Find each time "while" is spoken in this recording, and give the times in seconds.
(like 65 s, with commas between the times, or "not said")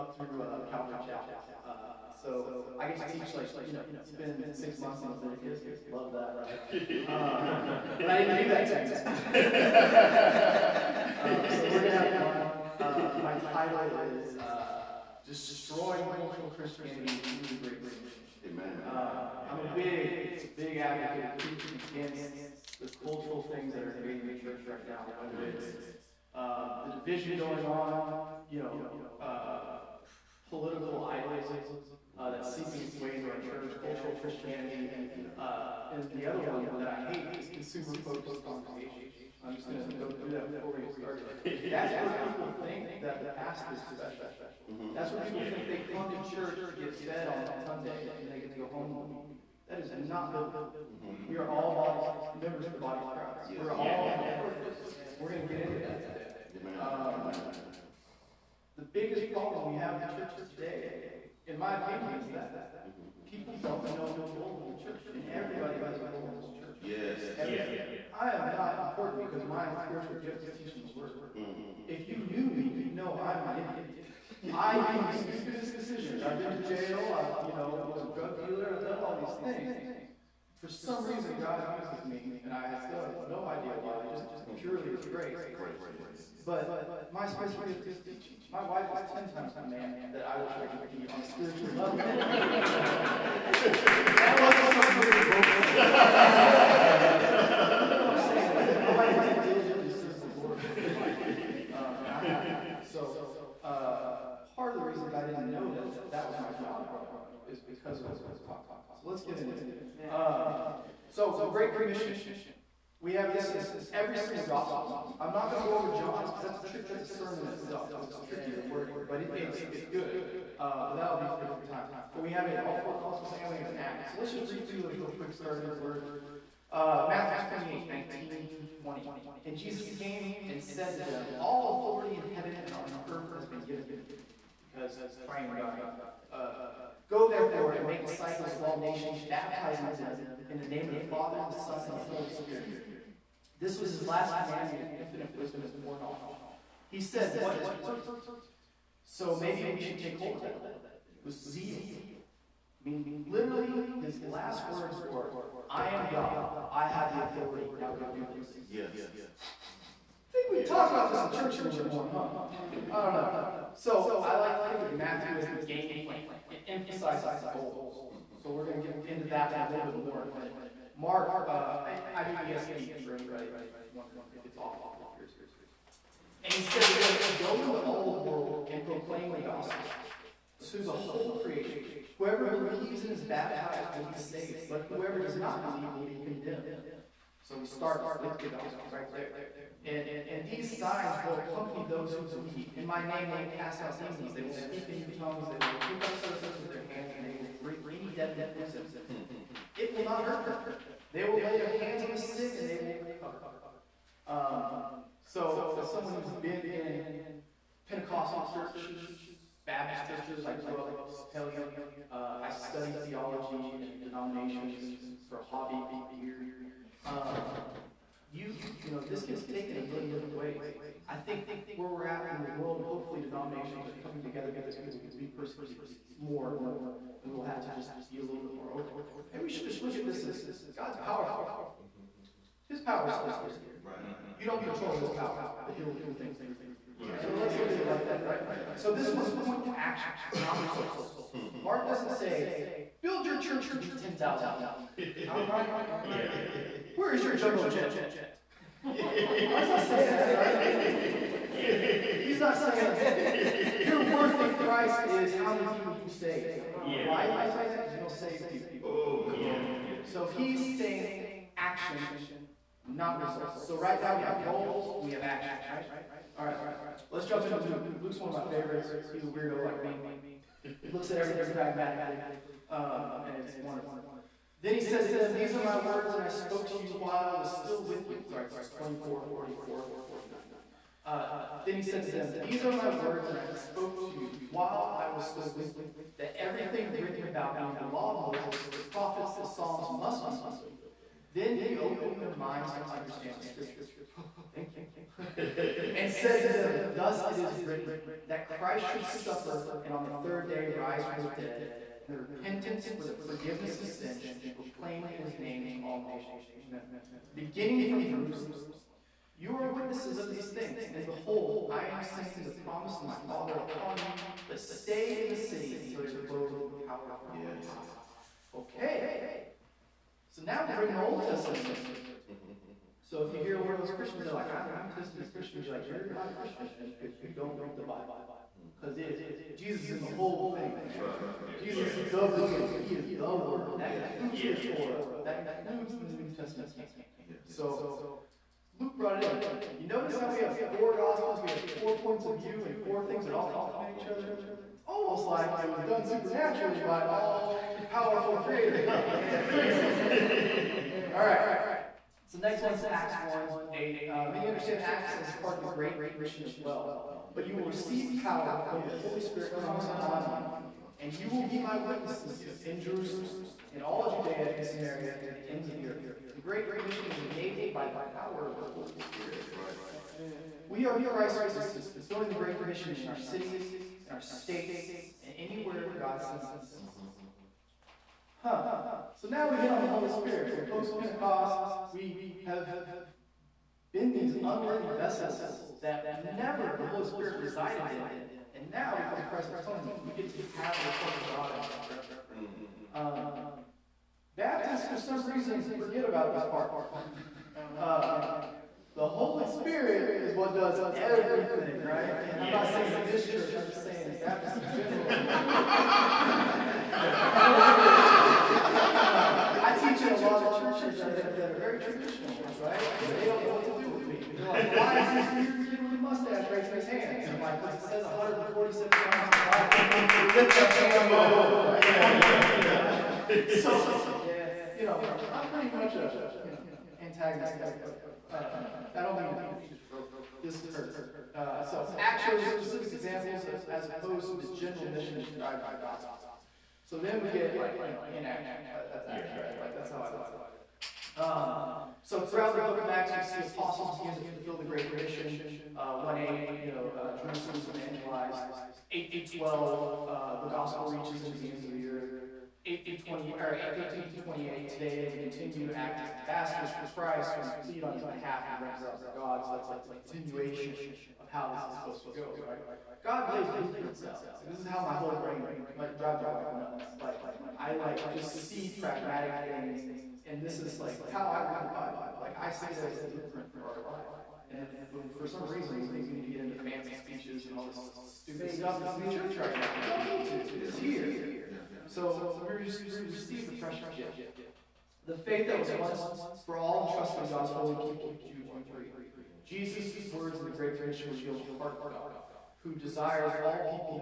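276 s, 284 s.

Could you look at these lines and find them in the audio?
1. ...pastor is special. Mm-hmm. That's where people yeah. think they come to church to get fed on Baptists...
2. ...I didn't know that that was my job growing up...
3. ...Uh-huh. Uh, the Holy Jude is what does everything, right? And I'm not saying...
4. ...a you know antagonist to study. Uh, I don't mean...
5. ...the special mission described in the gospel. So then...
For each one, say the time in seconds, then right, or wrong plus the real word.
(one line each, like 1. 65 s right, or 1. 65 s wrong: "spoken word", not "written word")
1. 43 s wrong: "Sunday", not "Baptists"
2. 105 s right
3. 397 s wrong: "Spirit", not "Jude"
4. 425 s wrong: "everybody", not "study"
5. 434 s wrong: "general", not "special".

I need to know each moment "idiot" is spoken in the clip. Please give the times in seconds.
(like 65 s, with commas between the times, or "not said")
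73 s.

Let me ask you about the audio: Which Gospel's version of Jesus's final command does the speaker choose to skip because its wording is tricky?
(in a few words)
John.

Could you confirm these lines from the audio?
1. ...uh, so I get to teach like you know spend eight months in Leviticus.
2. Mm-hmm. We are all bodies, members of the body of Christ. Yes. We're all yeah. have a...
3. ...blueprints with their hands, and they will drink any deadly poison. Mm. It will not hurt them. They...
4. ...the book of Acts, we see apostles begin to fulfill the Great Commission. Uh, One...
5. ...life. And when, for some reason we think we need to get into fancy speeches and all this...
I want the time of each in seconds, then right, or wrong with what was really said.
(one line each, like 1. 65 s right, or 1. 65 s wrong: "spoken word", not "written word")
1. 1 s wrong: "six", not "eight"
2. 50 s right
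3. 196 s wrong: "serpents", not "blueprints"
4. 442 s right
5. 473 s right.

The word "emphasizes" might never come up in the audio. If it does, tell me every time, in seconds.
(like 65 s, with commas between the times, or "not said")
166 s.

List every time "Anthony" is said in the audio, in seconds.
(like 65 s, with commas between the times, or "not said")
not said.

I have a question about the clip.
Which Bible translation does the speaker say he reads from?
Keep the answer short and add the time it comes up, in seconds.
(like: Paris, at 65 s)
ESV, at 172 s.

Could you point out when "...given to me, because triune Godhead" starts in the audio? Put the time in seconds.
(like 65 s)
133 s.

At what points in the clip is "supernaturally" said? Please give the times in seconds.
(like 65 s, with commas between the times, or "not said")
346 s.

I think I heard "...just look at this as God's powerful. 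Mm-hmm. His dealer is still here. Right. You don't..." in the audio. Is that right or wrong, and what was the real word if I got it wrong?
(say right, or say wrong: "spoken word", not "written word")
wrong: "power", not "dealer".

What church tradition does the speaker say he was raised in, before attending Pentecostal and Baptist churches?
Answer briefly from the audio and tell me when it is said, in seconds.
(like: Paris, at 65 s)
Episcopalian, at 211 s.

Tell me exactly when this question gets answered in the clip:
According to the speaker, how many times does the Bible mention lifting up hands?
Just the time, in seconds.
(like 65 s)
418 s.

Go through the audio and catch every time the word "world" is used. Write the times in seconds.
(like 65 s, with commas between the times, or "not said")
178 s, 222 s.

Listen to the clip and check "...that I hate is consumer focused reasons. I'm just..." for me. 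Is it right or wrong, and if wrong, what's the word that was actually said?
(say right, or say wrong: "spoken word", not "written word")
wrong: "congregations", not "reasons".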